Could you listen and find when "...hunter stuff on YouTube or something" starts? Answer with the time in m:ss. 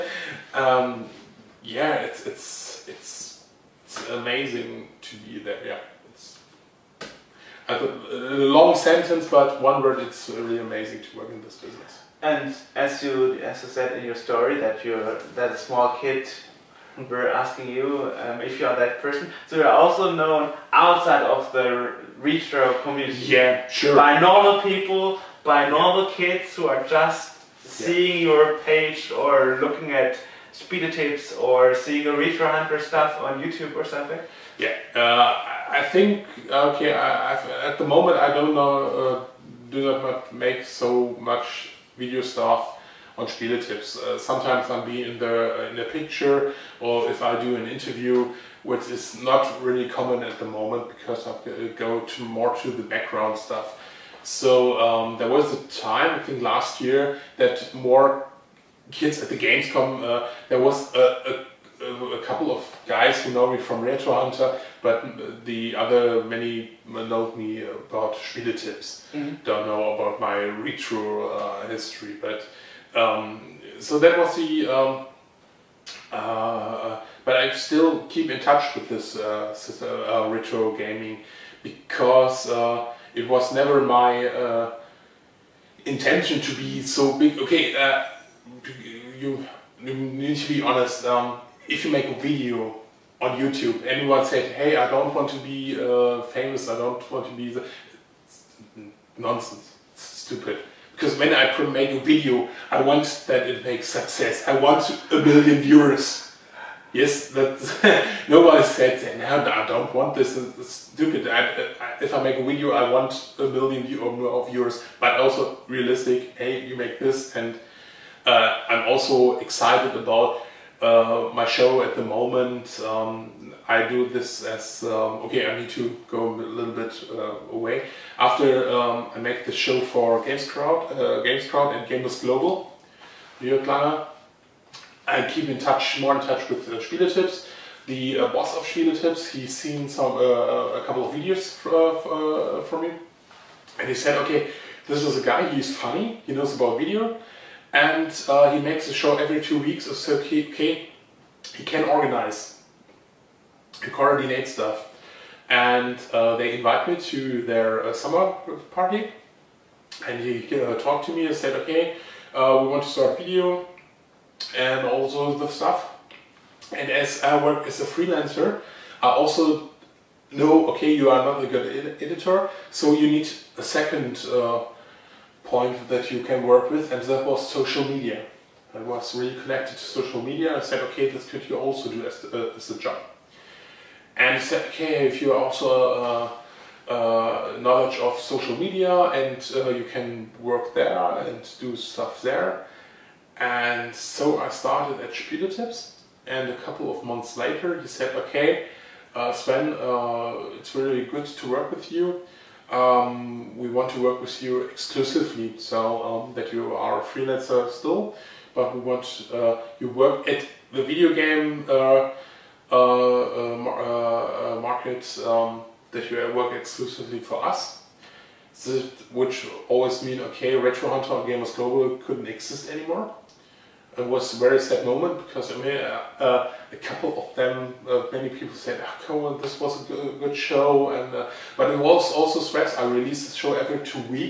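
0:32.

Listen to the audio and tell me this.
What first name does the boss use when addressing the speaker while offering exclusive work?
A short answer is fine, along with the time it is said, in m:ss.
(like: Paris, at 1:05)
Sven, at 3:19.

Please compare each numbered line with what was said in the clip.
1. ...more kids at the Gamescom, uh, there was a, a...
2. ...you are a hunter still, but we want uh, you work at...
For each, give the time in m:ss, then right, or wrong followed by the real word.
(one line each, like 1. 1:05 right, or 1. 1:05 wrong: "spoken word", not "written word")
1. 0:57 right
2. 3:26 wrong: "freelancer", not "hunter".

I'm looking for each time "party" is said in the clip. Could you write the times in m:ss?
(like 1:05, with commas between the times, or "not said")
2:38.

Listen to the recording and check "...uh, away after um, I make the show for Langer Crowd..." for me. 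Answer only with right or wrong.
wrong.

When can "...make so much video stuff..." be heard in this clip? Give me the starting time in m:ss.
0:40.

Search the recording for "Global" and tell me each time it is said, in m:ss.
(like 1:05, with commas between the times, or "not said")
2:12, 3:41.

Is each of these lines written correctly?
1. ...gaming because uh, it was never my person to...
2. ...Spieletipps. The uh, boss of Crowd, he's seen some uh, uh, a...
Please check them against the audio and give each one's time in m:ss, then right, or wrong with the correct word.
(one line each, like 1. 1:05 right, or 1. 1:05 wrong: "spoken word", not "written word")
1. 1:20 wrong: "intention", not "person"
2. 2:16 wrong: "Spieletipps", not "Crowd".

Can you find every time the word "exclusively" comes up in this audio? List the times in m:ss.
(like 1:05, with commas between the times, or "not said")
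3:24, 3:36.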